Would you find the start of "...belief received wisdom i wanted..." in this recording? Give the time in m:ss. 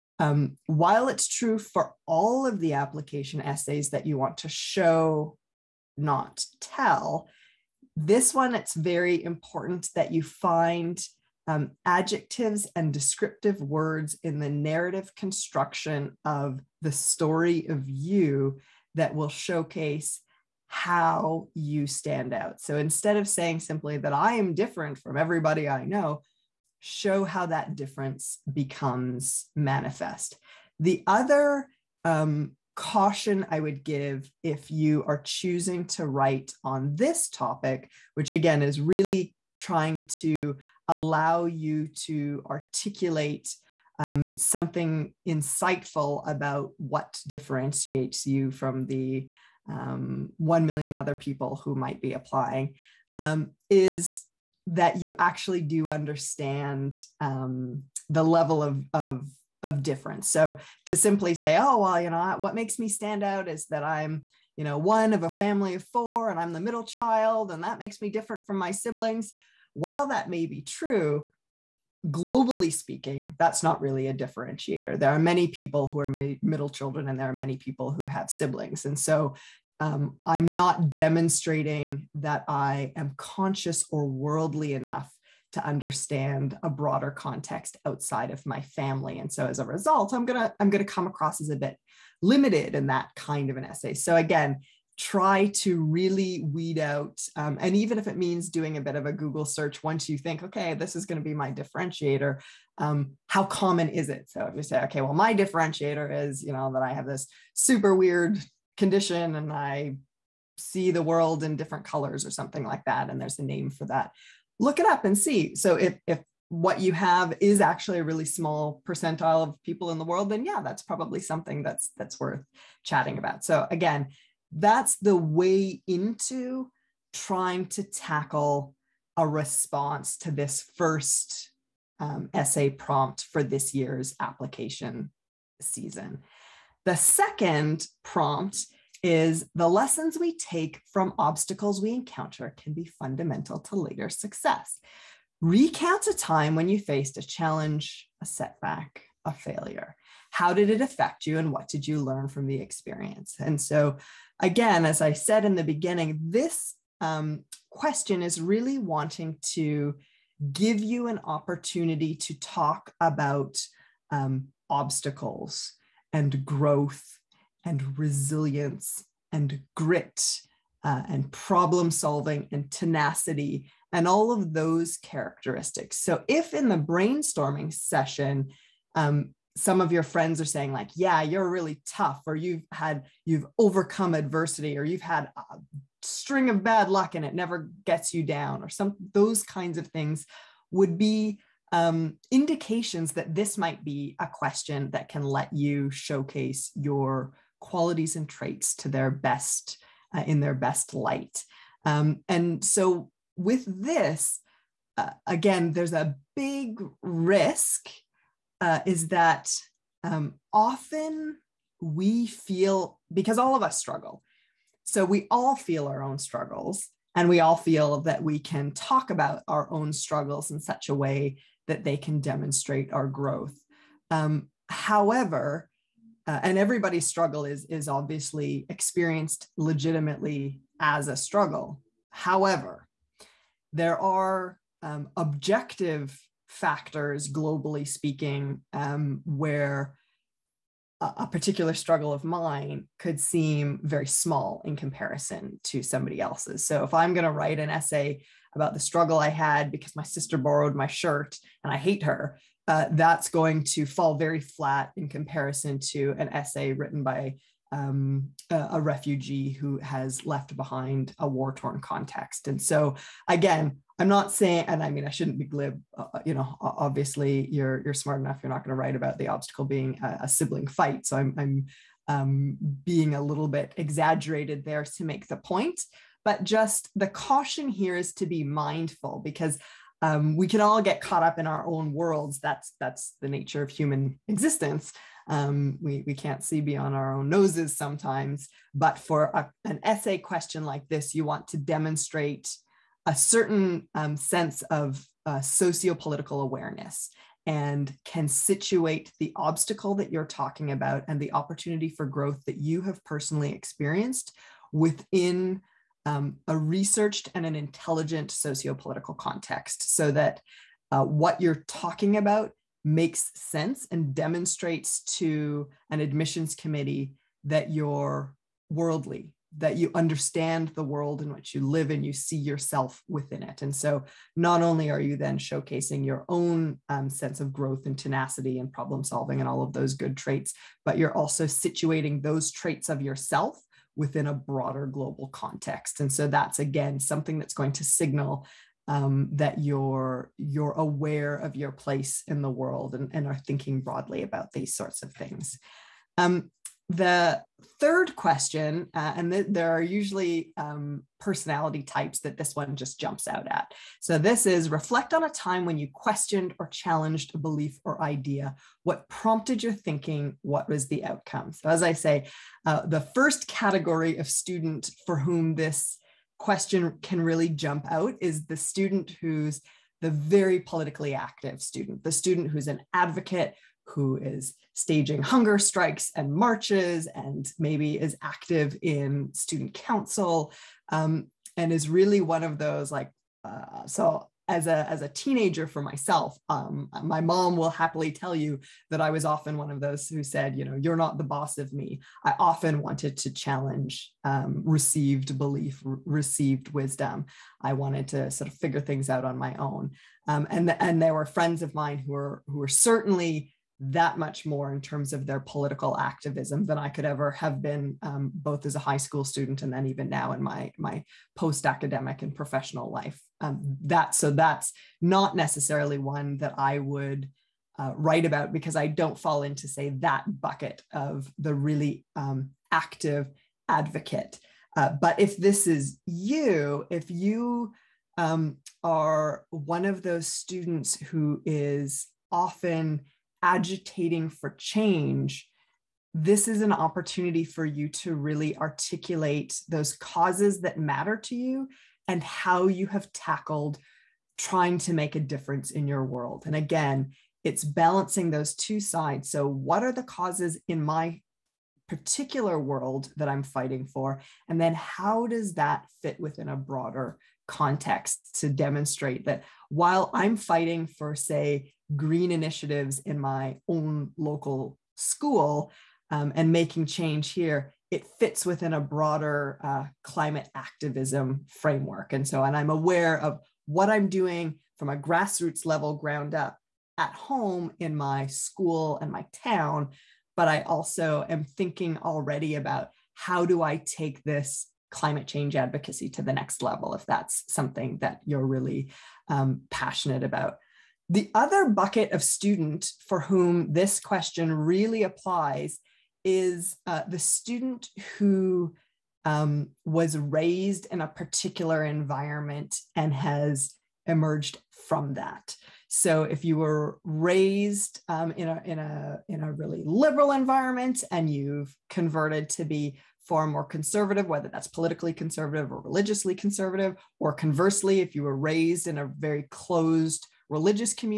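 6:35.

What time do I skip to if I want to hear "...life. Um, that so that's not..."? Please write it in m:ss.
6:52.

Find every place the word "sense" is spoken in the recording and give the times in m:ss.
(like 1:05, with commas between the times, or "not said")
4:54, 5:13, 5:27.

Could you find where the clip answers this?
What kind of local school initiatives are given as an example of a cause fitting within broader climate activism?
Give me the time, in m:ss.
7:41.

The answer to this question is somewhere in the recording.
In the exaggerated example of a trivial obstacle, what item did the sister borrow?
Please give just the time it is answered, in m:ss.
4:10.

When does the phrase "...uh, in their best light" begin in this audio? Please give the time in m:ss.
3:20.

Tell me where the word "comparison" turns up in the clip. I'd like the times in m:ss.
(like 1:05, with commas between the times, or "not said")
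4:04, 4:15.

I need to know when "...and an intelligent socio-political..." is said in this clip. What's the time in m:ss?
5:07.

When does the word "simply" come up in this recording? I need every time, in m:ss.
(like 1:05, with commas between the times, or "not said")
0:23, 1:00.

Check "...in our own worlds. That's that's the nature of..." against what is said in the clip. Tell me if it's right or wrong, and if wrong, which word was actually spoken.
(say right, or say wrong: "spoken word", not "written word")
right.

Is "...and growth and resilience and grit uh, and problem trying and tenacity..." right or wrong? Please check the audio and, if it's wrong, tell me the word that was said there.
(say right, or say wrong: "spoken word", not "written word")
wrong: "solving", not "trying".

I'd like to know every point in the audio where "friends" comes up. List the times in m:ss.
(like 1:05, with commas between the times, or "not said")
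3:00, 6:41.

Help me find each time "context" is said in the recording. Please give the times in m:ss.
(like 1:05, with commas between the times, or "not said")
1:27, 4:21, 5:09, 5:35, 7:37.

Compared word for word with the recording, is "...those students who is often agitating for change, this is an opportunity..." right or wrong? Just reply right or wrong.
right.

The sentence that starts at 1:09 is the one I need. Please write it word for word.
While that may be true, globally speaking, that's not really a differentiator.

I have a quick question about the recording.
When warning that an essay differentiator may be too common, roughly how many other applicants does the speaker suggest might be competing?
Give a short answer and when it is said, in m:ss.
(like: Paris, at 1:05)
1 million, at 0:50.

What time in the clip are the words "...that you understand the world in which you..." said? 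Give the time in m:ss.
5:19.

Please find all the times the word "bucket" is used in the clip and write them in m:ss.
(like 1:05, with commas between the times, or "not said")
7:00, 8:11.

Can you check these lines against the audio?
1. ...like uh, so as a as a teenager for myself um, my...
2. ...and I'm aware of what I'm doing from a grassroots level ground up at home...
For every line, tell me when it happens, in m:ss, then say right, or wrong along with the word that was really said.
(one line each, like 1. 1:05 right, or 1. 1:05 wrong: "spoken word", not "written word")
1. 6:22 right
2. 7:52 right.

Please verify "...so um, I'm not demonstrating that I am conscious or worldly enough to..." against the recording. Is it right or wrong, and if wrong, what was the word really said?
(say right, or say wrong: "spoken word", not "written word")
right.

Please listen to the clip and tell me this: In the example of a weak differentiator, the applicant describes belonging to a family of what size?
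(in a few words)
four.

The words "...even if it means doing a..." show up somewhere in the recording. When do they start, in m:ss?
1:37.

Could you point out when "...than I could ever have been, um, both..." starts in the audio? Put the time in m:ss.
6:46.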